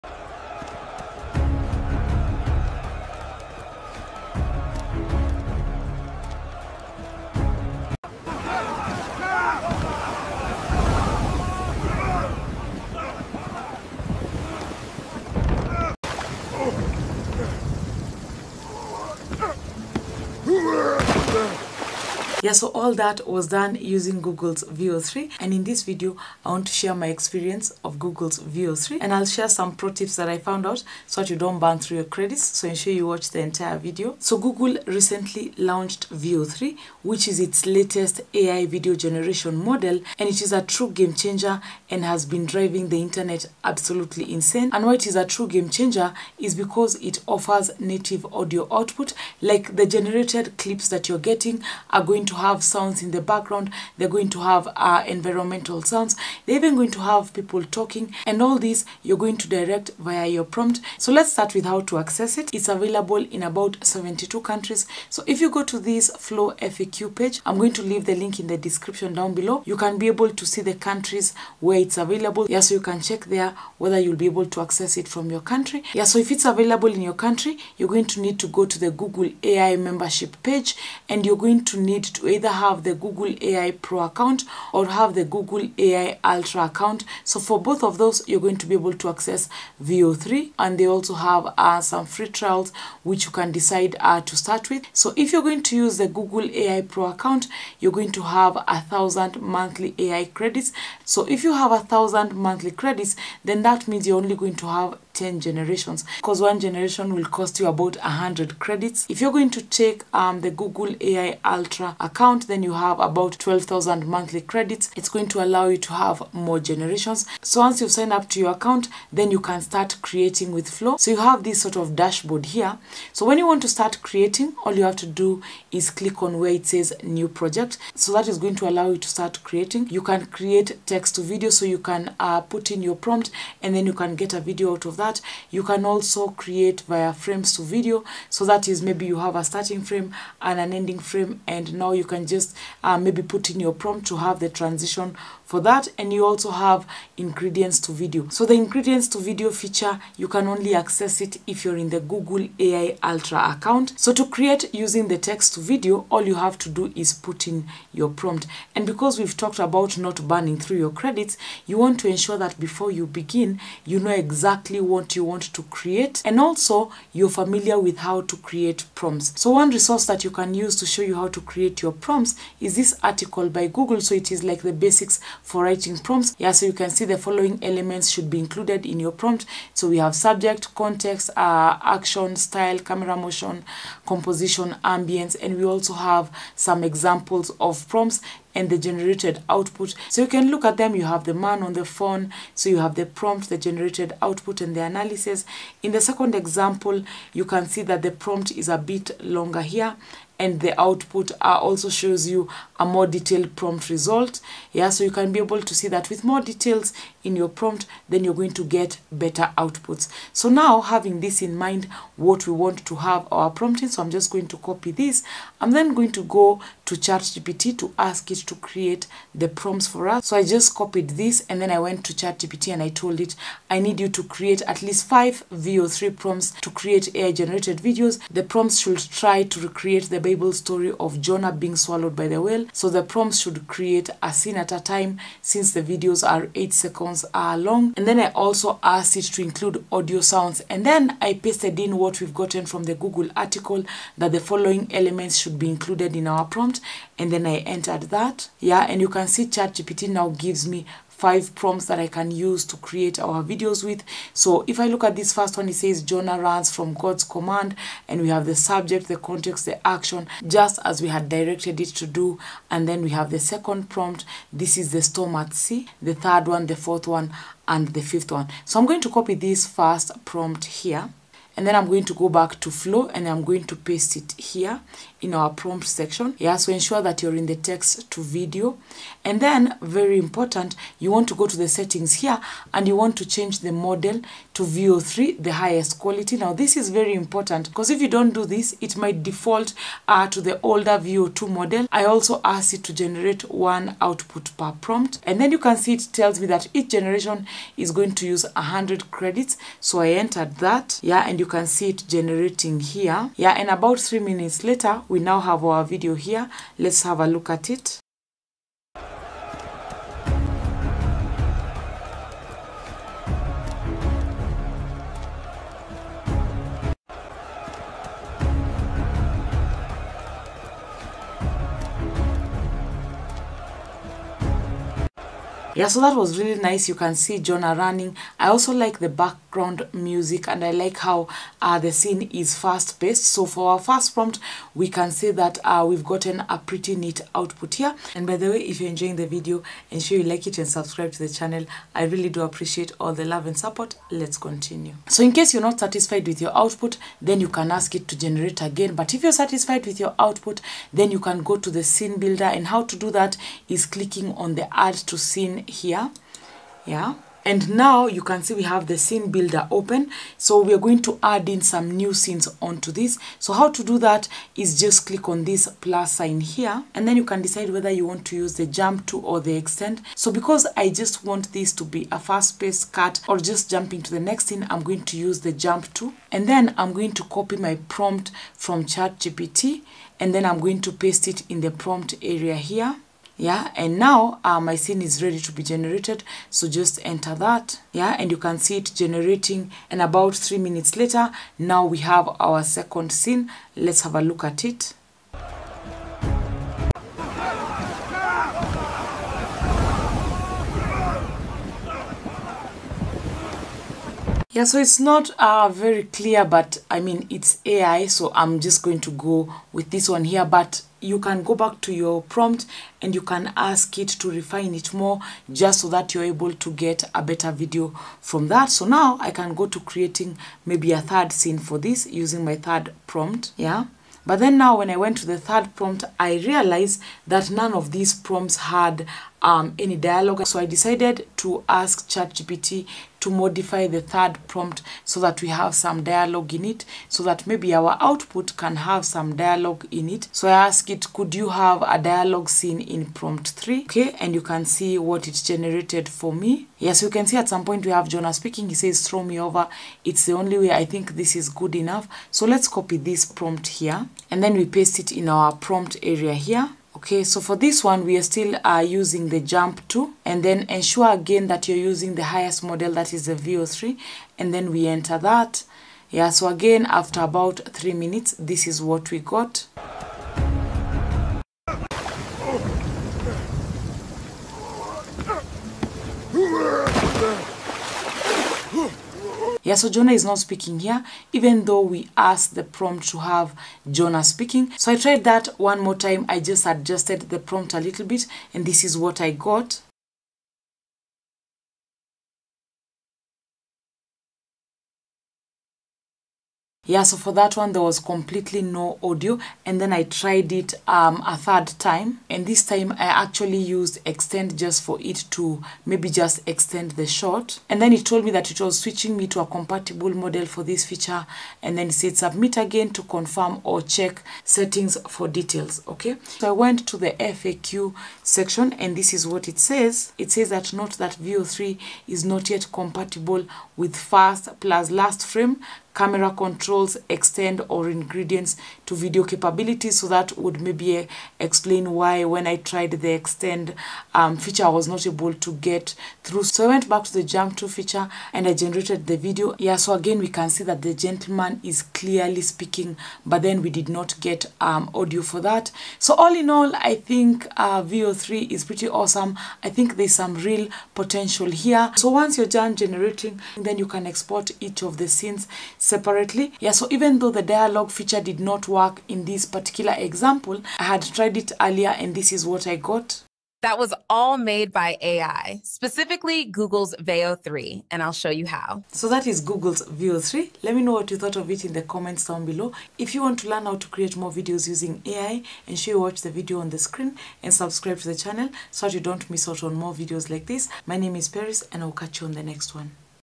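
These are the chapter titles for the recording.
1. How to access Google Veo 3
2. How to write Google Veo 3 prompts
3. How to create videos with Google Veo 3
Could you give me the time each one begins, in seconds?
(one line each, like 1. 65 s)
1. 62 s
2. 157 s
3. 273 s.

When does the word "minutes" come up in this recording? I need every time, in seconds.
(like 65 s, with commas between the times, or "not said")
304 s, 390 s, 467 s.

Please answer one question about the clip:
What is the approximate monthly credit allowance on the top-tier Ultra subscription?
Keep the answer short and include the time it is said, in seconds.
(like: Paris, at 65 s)
12,000, at 113 s.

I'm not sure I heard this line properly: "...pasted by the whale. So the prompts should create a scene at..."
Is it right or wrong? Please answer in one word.
wrong.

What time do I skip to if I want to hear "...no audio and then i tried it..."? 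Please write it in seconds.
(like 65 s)
498 s.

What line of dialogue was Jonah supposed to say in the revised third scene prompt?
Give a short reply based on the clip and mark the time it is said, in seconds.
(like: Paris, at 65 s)
Throw me over, at 449 s.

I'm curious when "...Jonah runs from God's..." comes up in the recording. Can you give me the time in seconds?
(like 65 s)
256 s.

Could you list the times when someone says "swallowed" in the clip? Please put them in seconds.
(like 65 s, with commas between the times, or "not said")
231 s.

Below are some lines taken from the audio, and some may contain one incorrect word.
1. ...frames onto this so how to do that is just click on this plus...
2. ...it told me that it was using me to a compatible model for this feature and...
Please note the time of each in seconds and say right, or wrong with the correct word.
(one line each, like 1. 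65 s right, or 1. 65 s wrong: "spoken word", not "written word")
1. 362 s wrong: "scenes", not "frames"
2. 507 s wrong: "switching", not "using".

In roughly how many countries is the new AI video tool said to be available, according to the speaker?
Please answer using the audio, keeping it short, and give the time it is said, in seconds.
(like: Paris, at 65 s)
72, at 63 s.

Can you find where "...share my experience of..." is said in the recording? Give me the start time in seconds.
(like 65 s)
26 s.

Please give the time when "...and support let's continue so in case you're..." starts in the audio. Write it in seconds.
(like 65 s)
343 s.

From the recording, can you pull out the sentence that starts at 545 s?
So all in all, I think uh, Veo 3 is pretty awesome.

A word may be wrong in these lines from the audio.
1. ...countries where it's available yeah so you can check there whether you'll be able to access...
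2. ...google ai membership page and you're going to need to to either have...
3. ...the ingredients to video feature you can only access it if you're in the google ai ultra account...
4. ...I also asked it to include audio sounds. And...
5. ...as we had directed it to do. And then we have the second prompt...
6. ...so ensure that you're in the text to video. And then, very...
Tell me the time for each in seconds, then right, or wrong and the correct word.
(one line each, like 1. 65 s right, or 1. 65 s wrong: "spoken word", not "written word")
1. 70 s right
2. 78 s right
3. 148 s right
4. 238 s right
5. 260 s right
6. 276 s right.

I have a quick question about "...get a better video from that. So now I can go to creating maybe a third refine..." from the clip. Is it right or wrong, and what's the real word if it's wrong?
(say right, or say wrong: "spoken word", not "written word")
wrong: "scene", not "refine".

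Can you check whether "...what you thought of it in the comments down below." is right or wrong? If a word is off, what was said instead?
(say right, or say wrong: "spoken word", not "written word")
right.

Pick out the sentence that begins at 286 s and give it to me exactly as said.
Now, this is very important because if you don't do this, it might default uh, to the older Veo 2 model.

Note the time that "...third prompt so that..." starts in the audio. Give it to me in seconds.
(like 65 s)
434 s.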